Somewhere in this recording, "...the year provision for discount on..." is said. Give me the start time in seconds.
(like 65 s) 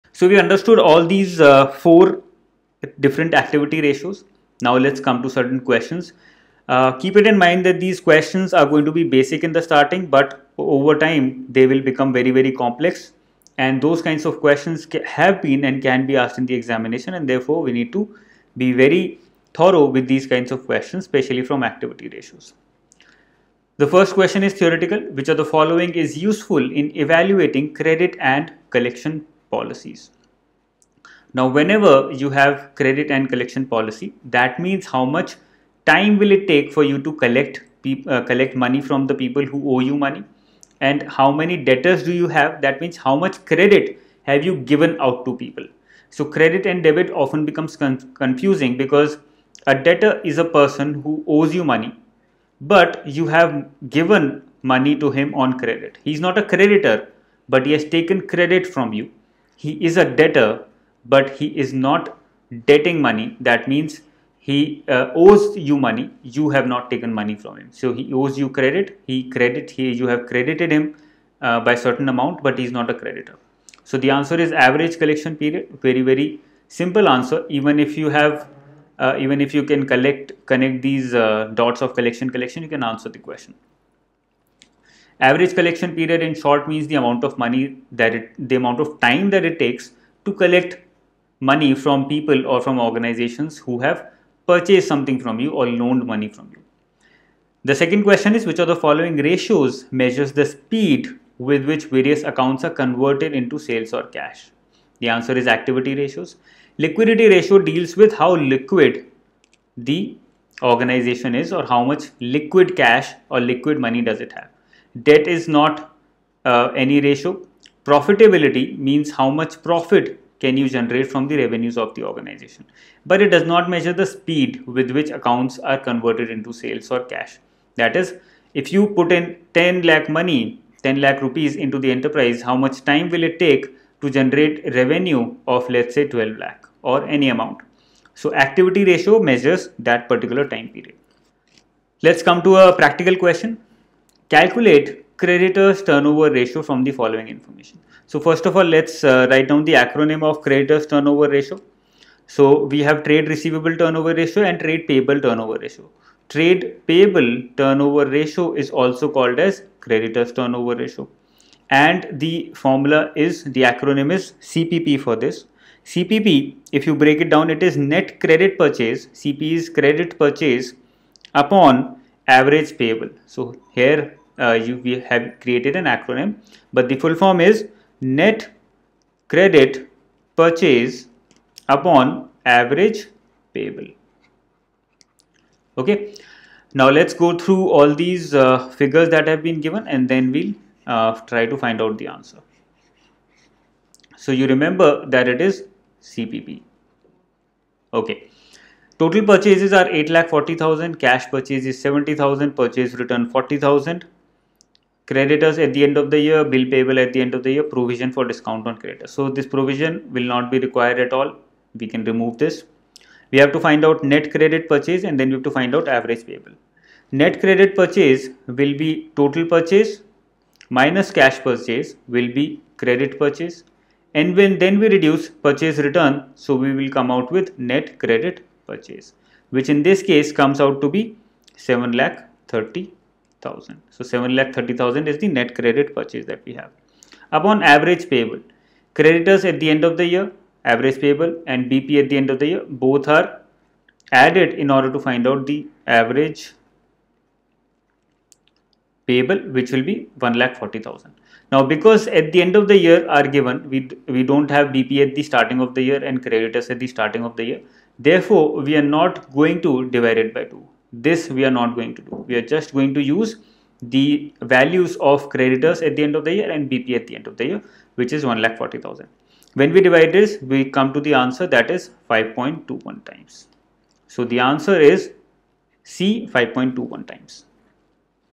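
207 s.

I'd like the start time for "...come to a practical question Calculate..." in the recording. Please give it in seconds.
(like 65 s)
142 s.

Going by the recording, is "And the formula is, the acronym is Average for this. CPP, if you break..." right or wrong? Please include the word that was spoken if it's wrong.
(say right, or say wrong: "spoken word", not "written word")
wrong: "CPP", not "Average".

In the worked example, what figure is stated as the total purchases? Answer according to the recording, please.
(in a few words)
8,40,000.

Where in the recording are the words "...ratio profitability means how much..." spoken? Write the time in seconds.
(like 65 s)
117 s.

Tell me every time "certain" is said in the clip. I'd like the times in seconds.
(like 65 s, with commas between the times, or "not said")
5 s, 71 s.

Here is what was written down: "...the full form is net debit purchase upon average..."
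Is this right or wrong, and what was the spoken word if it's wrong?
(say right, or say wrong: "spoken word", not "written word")
wrong: "credit", not "debit".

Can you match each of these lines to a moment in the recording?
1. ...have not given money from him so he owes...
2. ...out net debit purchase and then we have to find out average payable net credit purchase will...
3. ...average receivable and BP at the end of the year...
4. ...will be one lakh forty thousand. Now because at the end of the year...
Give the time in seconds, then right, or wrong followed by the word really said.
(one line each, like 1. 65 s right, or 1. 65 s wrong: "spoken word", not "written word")
1. 66 s wrong: "taken", not "given"
2. 213 s wrong: "credit", not "debit"
3. 240 s wrong: "payable", not "receivable"
4. 249 s right.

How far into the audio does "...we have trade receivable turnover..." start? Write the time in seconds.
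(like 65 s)
152 s.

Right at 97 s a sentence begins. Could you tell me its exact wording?
The second question is which of the following ratios measures the speed with which various accounts are converted into sales or cash?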